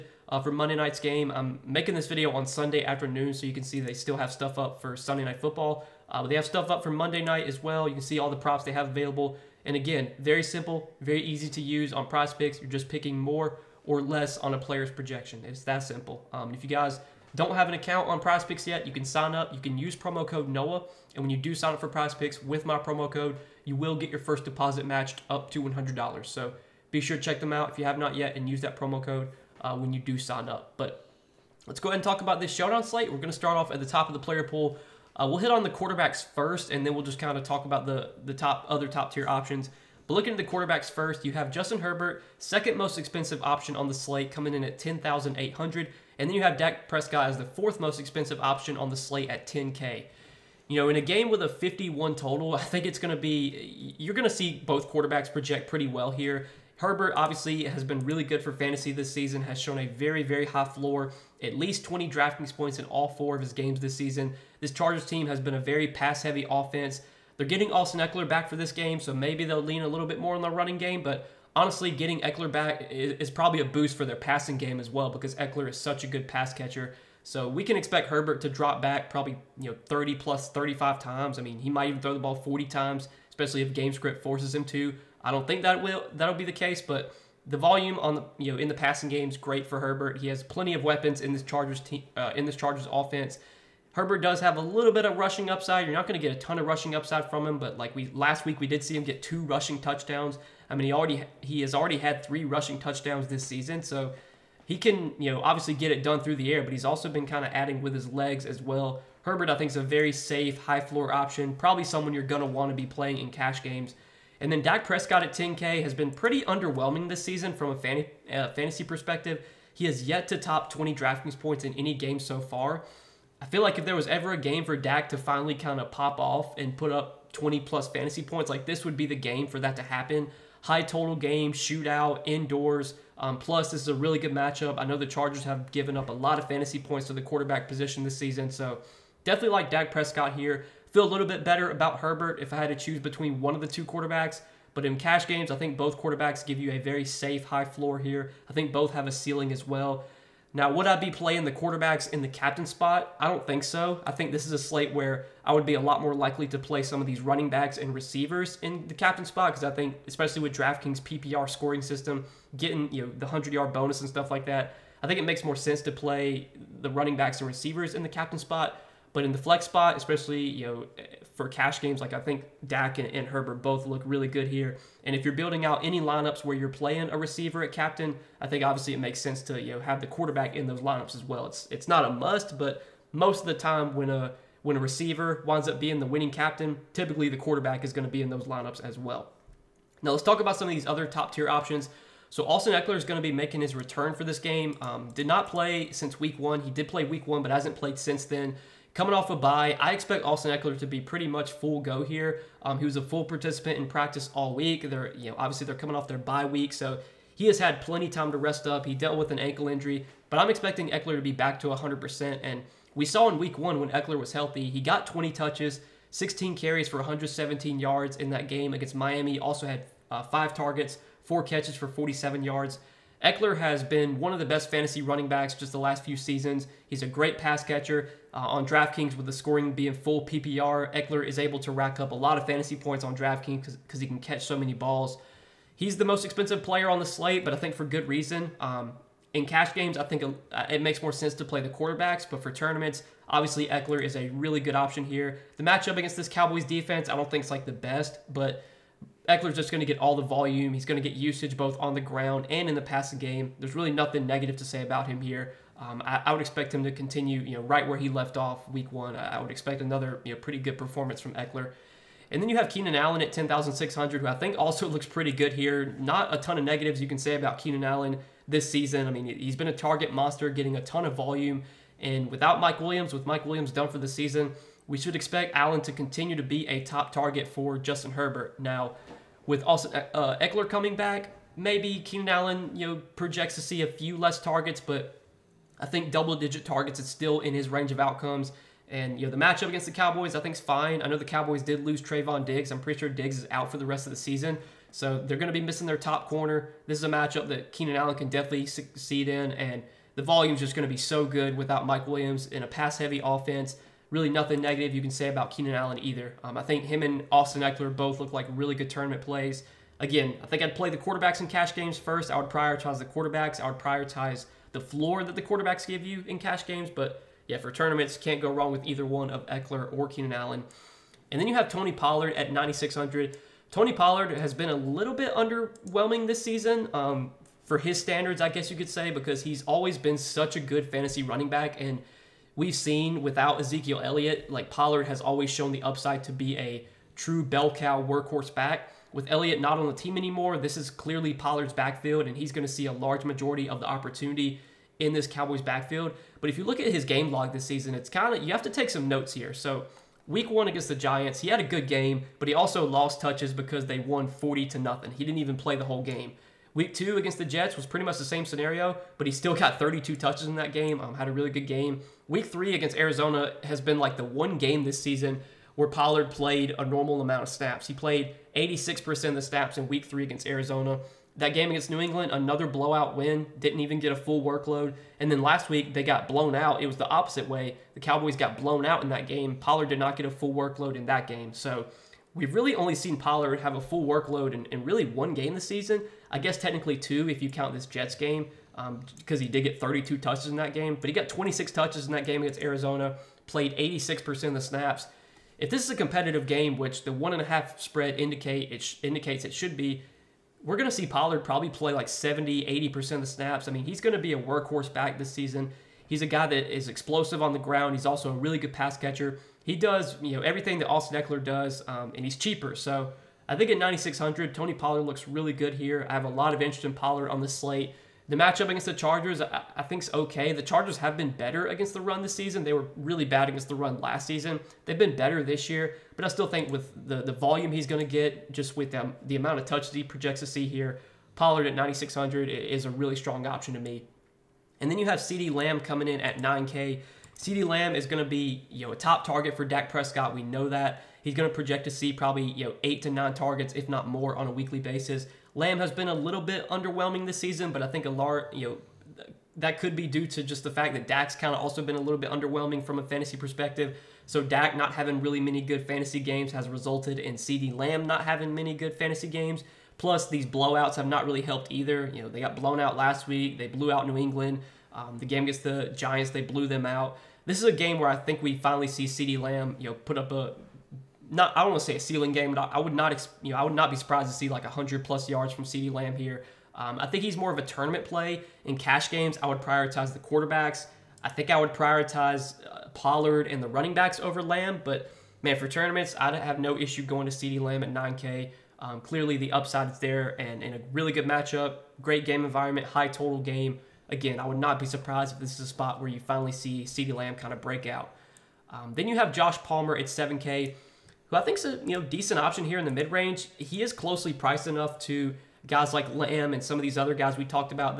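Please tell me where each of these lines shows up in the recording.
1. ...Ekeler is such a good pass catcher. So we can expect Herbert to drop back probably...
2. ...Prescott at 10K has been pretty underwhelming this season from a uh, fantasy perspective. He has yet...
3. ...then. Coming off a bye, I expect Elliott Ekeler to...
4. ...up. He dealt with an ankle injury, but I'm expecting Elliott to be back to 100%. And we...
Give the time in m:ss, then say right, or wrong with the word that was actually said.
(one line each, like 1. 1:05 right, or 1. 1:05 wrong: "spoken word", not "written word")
1. 1:15 right
2. 1:54 right
3. 3:18 wrong: "Austin", not "Elliott"
4. 3:28 wrong: "Ekeler", not "Elliott".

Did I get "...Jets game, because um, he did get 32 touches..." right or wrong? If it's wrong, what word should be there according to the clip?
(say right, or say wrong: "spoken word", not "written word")
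right.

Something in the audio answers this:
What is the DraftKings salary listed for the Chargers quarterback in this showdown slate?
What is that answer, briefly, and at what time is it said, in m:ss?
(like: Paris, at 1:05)
10,800, at 0:44.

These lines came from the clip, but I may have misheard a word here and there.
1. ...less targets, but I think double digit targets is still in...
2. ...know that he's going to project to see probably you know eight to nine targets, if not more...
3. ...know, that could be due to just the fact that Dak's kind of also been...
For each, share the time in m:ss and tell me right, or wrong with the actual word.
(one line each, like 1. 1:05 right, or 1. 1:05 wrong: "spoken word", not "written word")
1. 4:44 right
2. 7:20 right
3. 7:29 right.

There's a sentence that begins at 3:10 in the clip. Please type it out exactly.
Now let's talk about some of these other top tier options.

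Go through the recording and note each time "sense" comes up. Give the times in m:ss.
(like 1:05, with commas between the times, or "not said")
2:45, 2:59, 4:01.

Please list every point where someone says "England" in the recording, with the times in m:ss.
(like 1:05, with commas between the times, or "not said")
6:11, 7:44.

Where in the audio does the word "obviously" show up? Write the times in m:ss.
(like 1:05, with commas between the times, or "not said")
0:57, 1:45, 2:58, 3:25, 4:03.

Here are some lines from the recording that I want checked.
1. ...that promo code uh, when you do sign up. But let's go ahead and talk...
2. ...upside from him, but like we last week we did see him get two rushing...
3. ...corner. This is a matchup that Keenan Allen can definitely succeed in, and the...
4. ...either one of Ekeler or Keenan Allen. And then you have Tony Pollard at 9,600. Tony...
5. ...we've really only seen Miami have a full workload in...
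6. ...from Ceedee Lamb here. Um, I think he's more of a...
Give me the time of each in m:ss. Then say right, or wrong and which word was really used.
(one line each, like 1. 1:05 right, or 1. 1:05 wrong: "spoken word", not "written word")
1. 0:28 right
2. 1:36 right
3. 4:56 right
4. 5:18 right
5. 6:22 wrong: "Pollard", not "Miami"
6. 7:55 right.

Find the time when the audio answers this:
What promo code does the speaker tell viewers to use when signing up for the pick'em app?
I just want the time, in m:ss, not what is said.
0:20.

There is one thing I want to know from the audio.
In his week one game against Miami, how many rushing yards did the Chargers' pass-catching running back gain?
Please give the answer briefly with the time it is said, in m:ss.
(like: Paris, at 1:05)
117, at 3:36.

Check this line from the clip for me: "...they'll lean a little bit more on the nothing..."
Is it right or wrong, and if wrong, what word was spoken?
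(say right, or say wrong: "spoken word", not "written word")
wrong: "running", not "nothing".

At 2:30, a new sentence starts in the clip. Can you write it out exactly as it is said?
Now, would I be playing the quarterbacks in the captain spot?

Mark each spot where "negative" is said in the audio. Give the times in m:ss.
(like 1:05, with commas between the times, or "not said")
4:14, 4:26, 5:04.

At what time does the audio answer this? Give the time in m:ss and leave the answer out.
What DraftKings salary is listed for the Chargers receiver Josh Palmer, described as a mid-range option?
8:20.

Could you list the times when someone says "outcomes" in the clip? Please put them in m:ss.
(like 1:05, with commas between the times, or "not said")
4:47.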